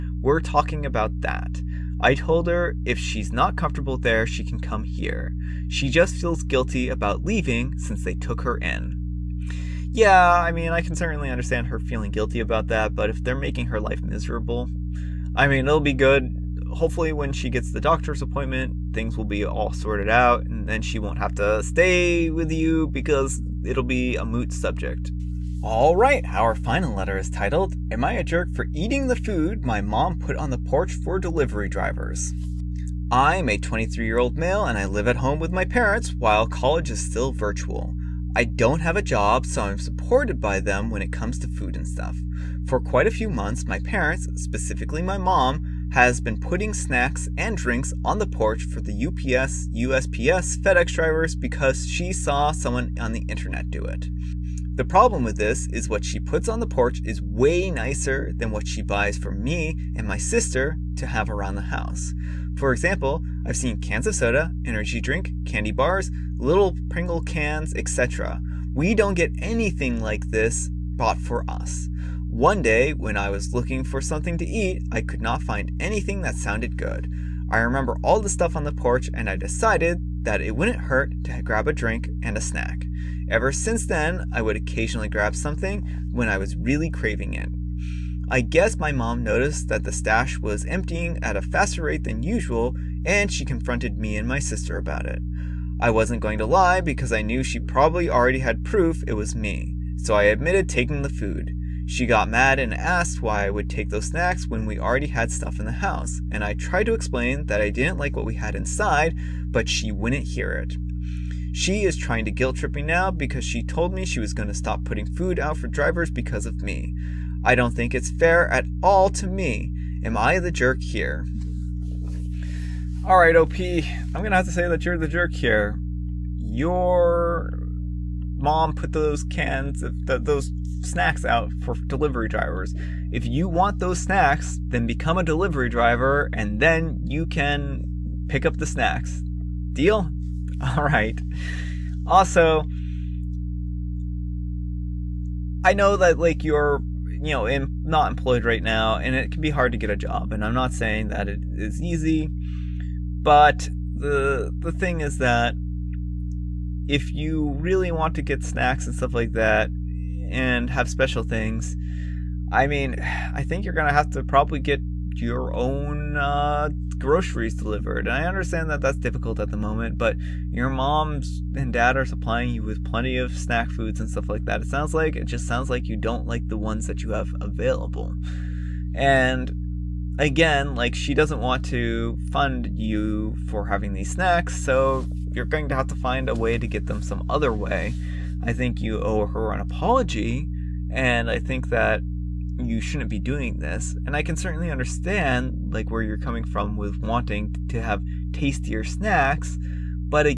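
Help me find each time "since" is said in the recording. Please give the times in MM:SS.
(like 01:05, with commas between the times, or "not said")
00:07, 01:23.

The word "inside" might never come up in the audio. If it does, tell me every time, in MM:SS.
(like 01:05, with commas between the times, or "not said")
01:48.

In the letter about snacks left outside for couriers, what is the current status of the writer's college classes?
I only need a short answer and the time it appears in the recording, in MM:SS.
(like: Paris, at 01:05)
virtual, at 00:37.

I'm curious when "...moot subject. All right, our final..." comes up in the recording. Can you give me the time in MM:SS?
00:24.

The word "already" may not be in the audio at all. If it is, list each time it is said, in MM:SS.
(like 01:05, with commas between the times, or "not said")
01:38, 01:44.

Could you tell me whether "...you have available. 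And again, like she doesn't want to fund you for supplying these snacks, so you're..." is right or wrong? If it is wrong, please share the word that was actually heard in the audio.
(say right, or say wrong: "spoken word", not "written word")
wrong: "having", not "supplying".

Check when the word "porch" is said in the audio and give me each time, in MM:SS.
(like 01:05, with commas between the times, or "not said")
00:30, 00:48, 00:56, 01:18.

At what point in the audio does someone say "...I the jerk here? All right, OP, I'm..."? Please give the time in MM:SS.
02:00.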